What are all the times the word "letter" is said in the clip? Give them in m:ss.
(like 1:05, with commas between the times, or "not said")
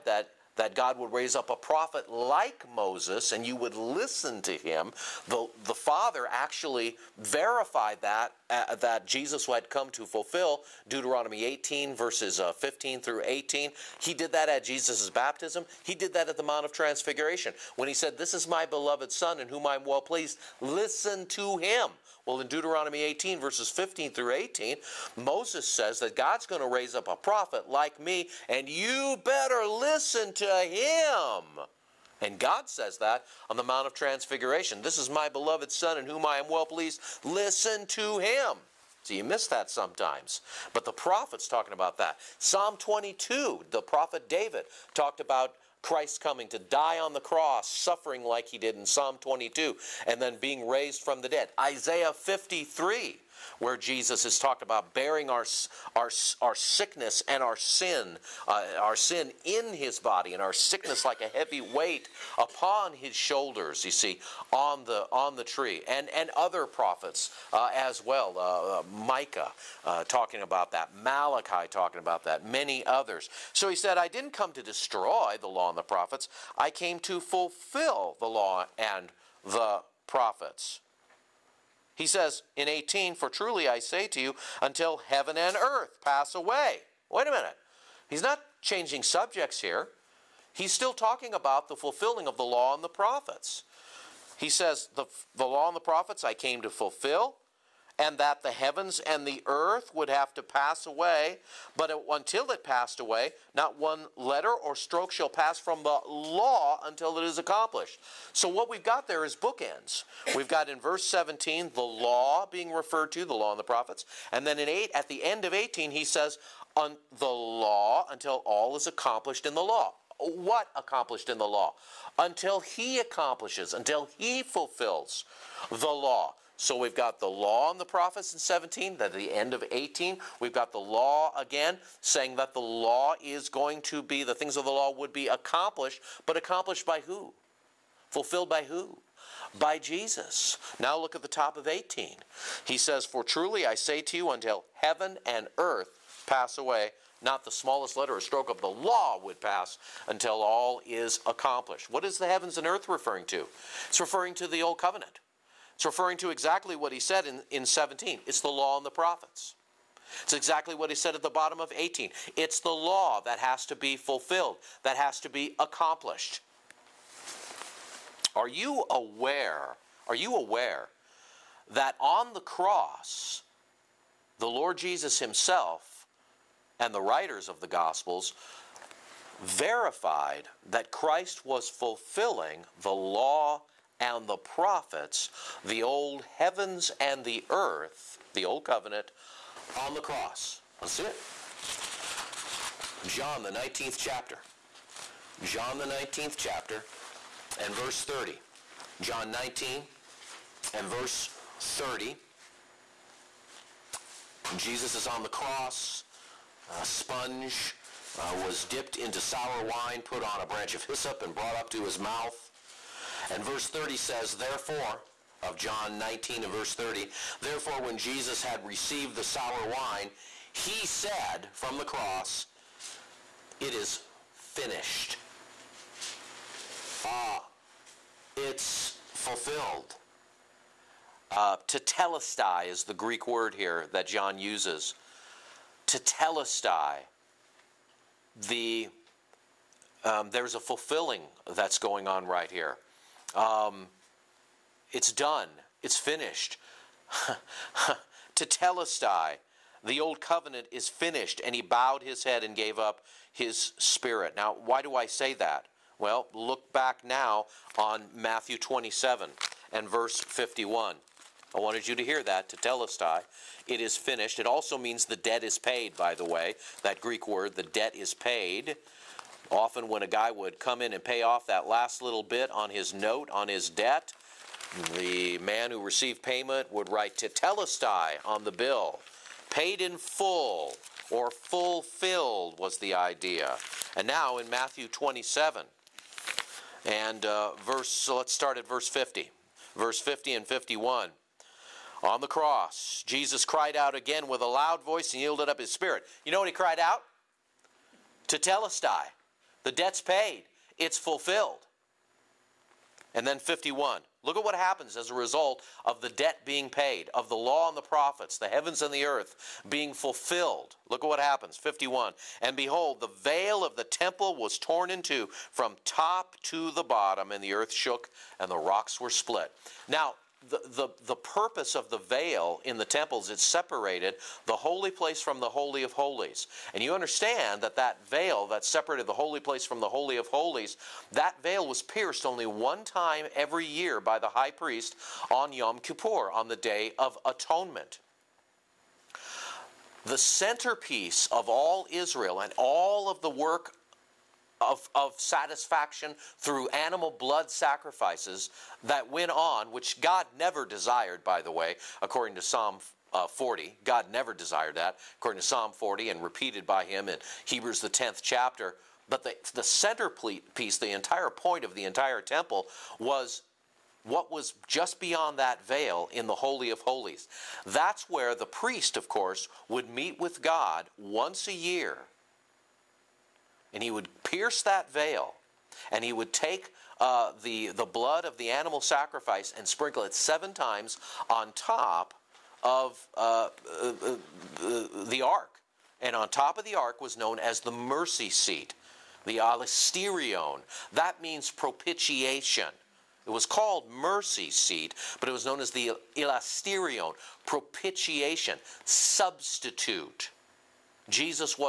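1:44, 2:27.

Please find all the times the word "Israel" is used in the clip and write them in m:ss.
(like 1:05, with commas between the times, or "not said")
5:41.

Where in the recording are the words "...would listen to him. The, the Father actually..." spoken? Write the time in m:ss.
0:03.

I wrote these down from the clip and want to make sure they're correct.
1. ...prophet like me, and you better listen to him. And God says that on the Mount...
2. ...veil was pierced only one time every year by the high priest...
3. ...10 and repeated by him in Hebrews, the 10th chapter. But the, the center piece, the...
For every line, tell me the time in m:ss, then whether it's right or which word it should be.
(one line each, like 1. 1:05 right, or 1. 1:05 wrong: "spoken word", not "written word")
1. 0:27 right
2. 5:31 right
3. 5:55 wrong: "40", not "10".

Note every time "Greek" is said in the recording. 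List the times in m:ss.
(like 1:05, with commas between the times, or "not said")
3:52, 4:26.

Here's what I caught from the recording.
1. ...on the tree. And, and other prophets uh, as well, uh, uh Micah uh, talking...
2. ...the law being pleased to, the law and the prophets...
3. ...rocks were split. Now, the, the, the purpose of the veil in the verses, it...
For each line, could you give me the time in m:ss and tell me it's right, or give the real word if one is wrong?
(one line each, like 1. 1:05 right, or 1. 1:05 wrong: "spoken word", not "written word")
1. 1:05 right
2. 1:51 wrong: "referred", not "pleased"
3. 5:18 wrong: "temples", not "verses".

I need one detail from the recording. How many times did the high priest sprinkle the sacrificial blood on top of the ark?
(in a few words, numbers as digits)
7.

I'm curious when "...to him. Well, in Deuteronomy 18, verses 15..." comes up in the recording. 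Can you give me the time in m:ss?
0:21.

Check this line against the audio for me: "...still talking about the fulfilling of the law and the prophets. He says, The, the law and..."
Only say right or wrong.
right.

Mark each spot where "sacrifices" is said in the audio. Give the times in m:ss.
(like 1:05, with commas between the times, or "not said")
5:47, 6:18.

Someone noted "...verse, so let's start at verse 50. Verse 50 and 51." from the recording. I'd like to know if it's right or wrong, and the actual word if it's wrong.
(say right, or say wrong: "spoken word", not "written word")
right.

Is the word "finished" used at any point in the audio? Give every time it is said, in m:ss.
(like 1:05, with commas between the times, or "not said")
3:44, 4:05, 4:10, 4:23.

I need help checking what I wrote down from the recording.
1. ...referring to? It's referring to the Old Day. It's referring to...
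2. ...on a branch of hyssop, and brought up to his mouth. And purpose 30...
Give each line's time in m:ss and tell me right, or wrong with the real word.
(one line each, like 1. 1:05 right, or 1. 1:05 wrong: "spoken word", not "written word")
1. 2:32 wrong: "Covenant", not "Day"
2. 3:30 wrong: "verse", not "purpose".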